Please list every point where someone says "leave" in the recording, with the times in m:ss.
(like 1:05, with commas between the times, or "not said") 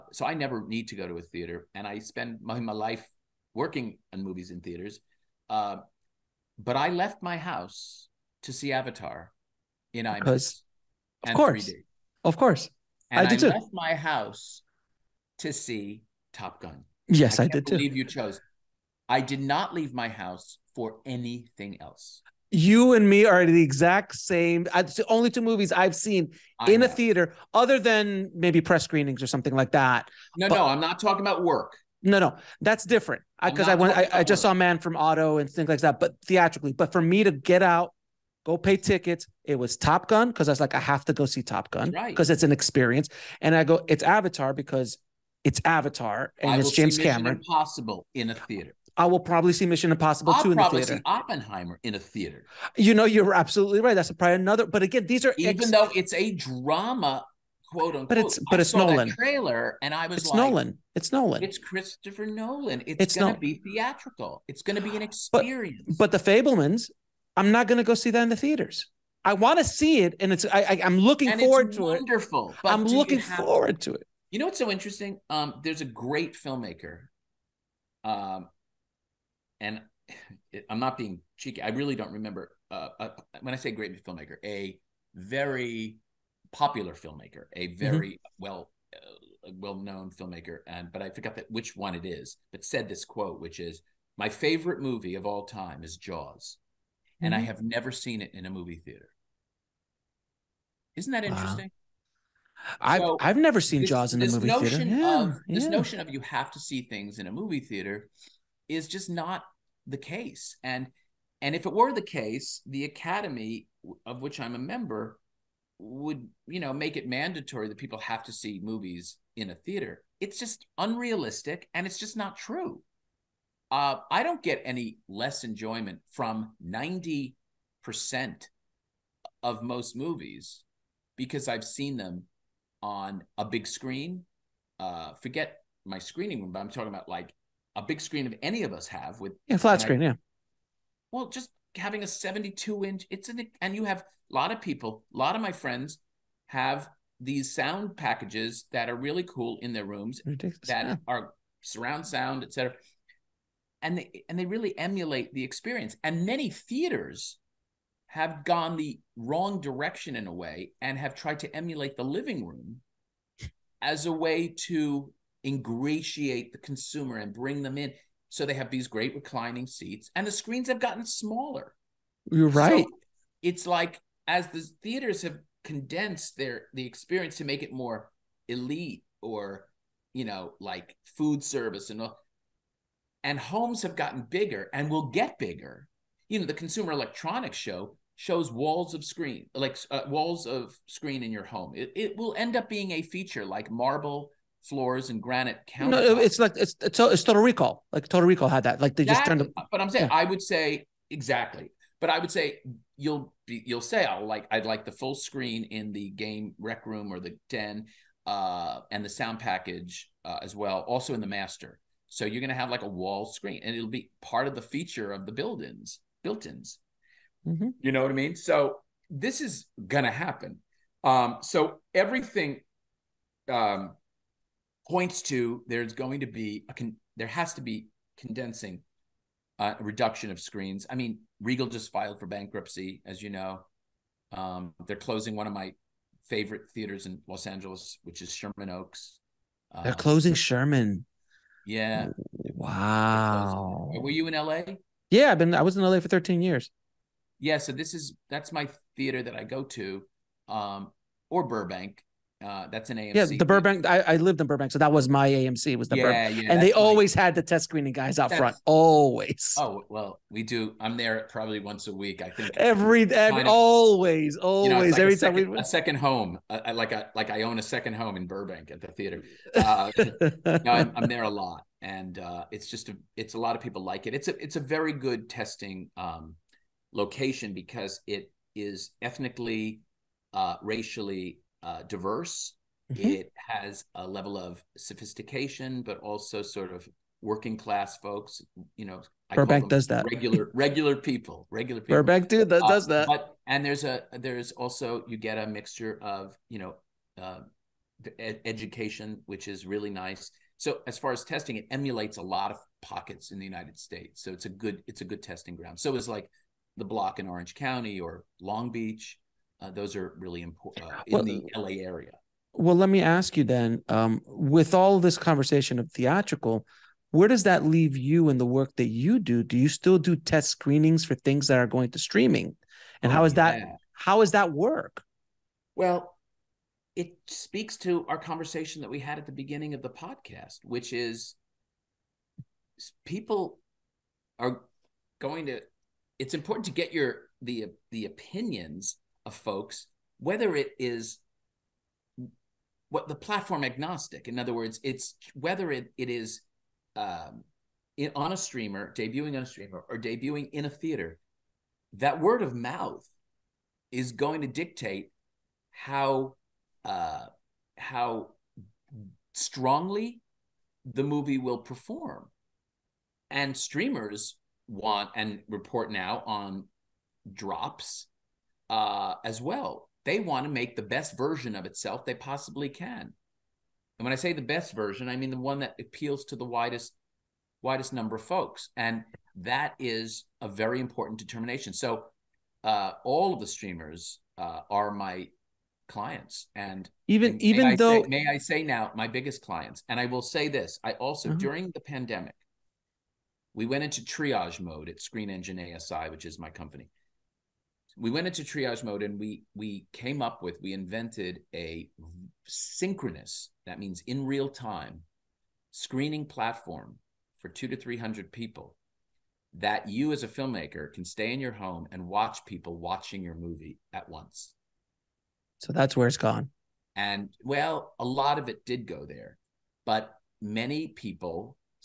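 0:19, 5:17.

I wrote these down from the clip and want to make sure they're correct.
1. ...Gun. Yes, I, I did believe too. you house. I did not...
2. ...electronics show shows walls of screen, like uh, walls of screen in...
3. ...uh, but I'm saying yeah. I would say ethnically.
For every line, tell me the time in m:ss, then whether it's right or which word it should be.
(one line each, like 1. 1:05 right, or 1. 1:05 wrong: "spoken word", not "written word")
1. 0:16 wrong: "chose", not "house"
2. 3:06 right
3. 3:19 wrong: "exactly", not "ethnically".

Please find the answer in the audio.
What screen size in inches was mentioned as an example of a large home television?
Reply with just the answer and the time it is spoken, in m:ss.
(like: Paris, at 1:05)
72, at 2:22.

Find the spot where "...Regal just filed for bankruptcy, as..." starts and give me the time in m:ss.
3:51.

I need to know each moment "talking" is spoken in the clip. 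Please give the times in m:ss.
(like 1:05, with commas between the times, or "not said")
0:30, 2:16.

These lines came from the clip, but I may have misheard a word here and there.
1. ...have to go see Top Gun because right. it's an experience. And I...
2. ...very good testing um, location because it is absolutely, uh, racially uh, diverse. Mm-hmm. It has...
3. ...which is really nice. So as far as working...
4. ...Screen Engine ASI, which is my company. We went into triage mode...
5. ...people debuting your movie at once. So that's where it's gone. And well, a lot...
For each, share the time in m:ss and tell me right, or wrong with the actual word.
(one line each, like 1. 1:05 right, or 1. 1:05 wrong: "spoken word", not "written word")
1. 0:40 right
2. 4:34 wrong: "ethnically", not "absolutely"
3. 4:59 wrong: "testing", not "working"
4. 6:35 right
5. 6:52 wrong: "watching", not "debuting".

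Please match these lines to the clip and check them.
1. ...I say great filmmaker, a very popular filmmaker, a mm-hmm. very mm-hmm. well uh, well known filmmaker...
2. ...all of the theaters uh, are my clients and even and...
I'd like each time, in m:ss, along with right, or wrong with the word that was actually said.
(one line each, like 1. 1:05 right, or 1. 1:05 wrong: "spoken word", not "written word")
1. 1:23 right
2. 6:23 wrong: "streamers", not "theaters".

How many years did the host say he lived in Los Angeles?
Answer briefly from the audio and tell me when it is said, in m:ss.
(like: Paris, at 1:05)
13, at 4:06.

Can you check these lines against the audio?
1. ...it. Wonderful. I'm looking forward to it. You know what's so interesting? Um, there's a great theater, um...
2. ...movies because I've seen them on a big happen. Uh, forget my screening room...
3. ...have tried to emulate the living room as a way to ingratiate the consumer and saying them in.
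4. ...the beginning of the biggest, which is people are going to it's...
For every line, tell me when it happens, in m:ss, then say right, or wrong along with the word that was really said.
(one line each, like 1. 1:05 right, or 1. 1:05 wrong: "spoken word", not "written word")
1. 1:12 wrong: "filmmaker", not "theater"
2. 2:09 wrong: "screen", not "happen"
3. 2:40 wrong: "bring", not "saying"
4. 5:29 wrong: "podcast", not "biggest".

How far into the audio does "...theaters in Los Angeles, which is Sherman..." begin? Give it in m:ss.
3:56.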